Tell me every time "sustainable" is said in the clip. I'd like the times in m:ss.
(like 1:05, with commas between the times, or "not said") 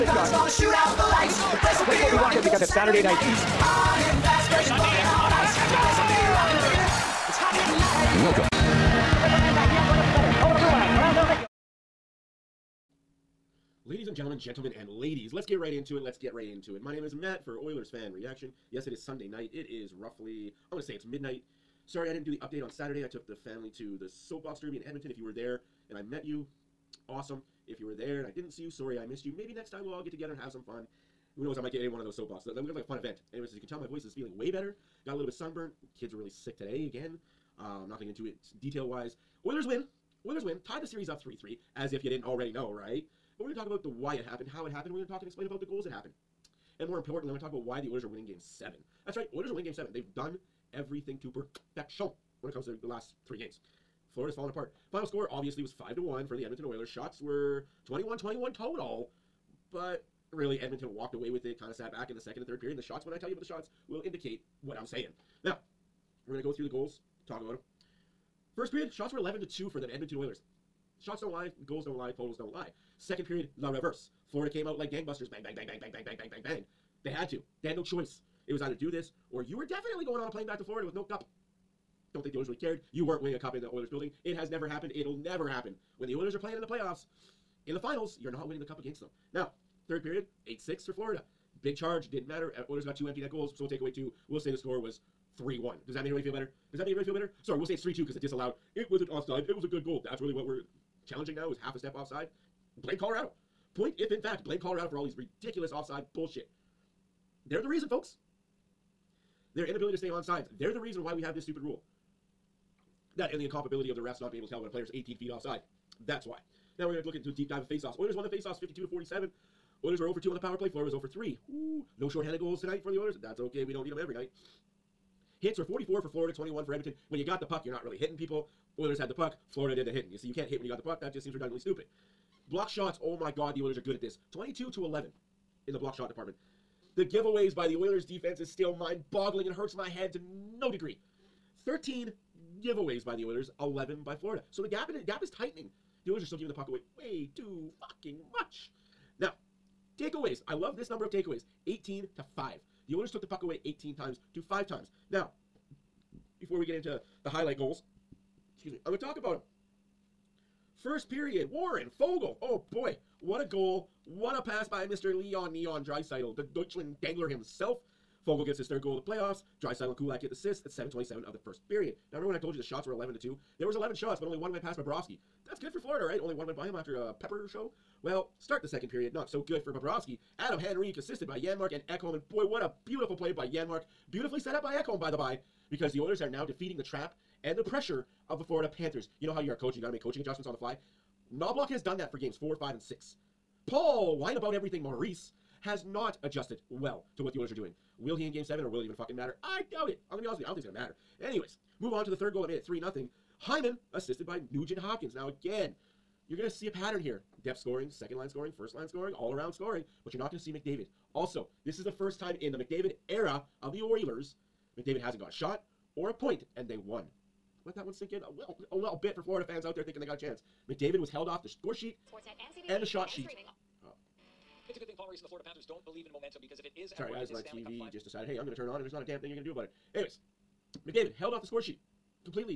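not said.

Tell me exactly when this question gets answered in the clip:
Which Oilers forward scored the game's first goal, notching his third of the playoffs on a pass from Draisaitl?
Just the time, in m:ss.
2:41.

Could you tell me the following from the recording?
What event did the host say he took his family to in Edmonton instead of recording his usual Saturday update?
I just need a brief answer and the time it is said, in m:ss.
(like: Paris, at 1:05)
Soapbox Derby, at 0:24.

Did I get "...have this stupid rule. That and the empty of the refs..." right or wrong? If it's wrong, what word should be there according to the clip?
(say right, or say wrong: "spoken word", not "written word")
wrong: "incompatibility", not "empty".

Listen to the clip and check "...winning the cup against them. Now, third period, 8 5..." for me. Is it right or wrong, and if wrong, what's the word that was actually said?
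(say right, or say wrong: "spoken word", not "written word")
wrong: "6", not "5".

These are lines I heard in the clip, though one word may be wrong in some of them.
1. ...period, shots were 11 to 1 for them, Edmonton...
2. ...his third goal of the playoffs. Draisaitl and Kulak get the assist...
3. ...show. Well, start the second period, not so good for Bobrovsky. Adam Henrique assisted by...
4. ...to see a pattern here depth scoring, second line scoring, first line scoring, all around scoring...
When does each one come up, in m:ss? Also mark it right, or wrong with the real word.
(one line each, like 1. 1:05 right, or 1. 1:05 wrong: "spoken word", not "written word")
1. 1:08 wrong: "2", not "1"
2. 2:48 right
3. 2:57 right
4. 3:26 right.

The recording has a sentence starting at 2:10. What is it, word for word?
You see, you can't hit when you got the puck.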